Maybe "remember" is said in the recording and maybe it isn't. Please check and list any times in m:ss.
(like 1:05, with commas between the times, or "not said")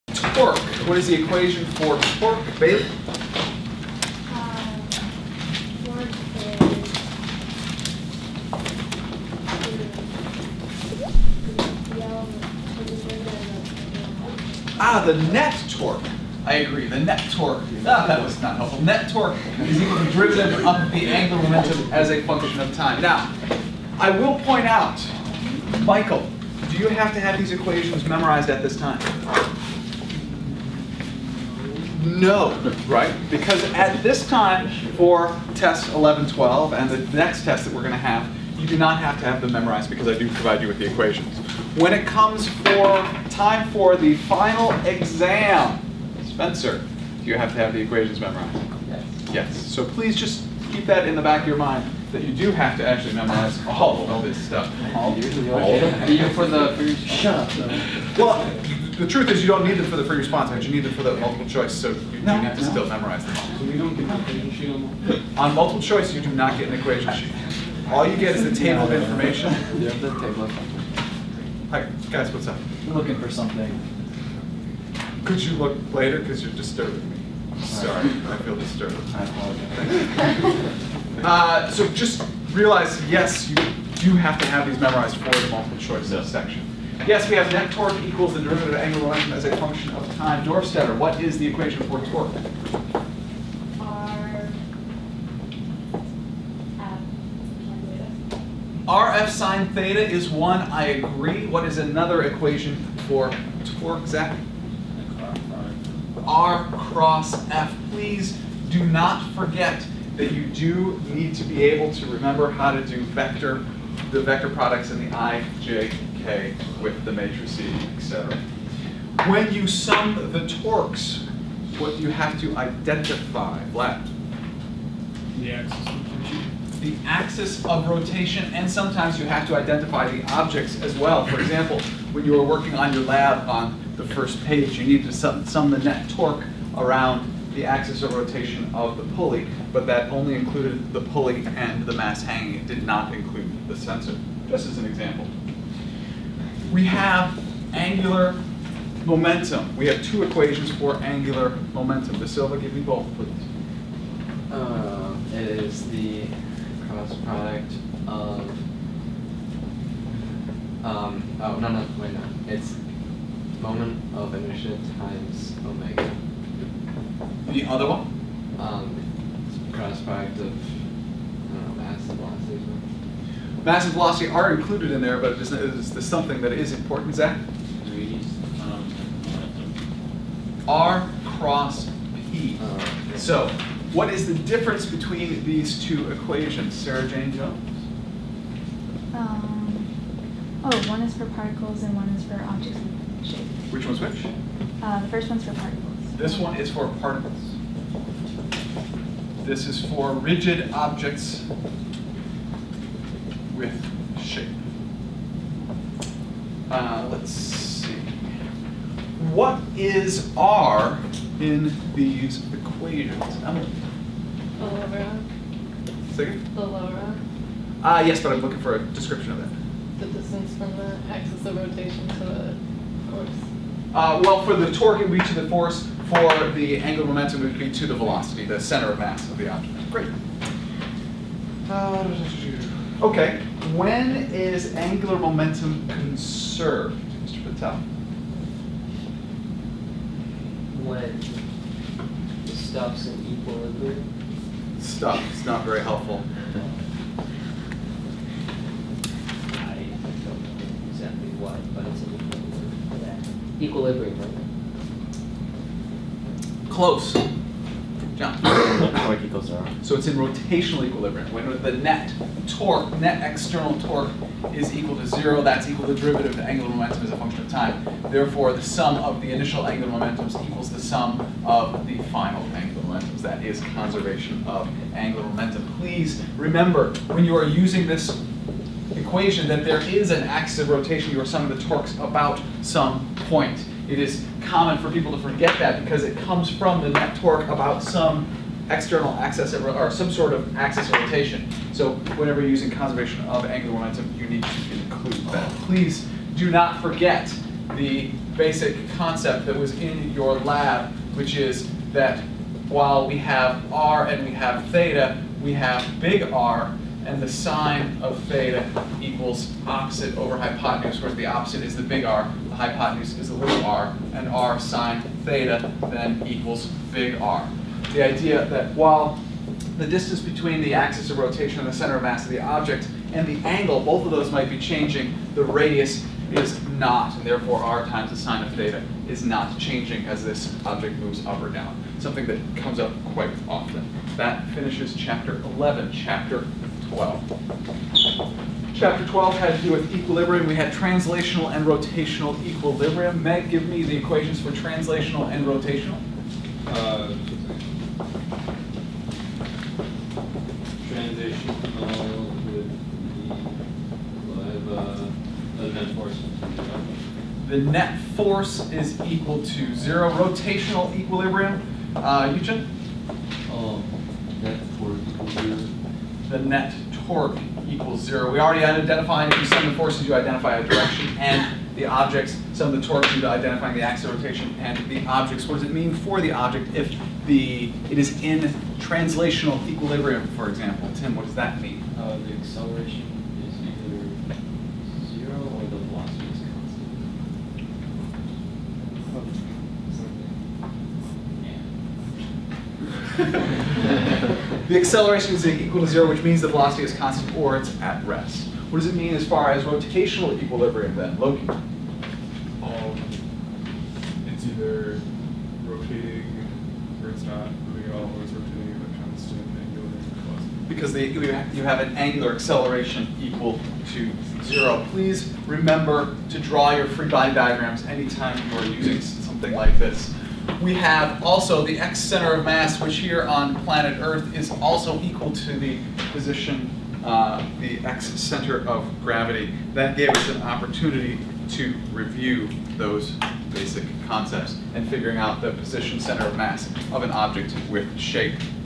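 1:52, 4:36, 6:55.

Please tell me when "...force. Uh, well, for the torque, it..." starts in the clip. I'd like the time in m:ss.
3:43.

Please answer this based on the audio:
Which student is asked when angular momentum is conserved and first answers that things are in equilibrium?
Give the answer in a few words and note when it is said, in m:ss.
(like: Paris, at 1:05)
Mr. Patel, at 3:57.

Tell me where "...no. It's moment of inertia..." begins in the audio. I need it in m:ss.
2:42.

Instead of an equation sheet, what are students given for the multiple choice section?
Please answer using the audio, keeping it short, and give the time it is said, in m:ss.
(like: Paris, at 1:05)
A table of information, at 1:08.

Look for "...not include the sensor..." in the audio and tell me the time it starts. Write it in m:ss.
2:22.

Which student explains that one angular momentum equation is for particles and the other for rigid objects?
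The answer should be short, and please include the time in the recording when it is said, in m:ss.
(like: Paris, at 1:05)
Sarah Jane Jones, at 3:06.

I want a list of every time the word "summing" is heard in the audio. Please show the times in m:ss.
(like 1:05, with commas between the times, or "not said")
4:41.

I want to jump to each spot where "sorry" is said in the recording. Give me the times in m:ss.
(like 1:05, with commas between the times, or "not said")
1:17.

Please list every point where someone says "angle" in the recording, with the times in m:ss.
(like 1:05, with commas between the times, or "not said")
5:23.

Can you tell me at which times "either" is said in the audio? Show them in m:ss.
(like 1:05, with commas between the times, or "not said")
6:44.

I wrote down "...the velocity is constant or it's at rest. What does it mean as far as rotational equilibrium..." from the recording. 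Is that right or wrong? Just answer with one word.
right.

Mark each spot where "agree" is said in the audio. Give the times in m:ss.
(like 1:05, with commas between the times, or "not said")
0:16, 1:40.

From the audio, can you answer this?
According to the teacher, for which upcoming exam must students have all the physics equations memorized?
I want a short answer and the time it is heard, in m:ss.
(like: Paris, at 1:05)
Final exam, at 0:44.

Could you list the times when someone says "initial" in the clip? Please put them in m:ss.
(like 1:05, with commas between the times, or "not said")
4:29.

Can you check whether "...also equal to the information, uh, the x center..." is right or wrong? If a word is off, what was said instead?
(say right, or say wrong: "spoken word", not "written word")
wrong: "position", not "information".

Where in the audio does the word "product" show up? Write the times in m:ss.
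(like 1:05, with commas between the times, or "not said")
1:54, 2:37, 2:50.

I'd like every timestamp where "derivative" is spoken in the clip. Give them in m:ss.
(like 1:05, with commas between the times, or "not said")
0:20, 1:28, 4:25.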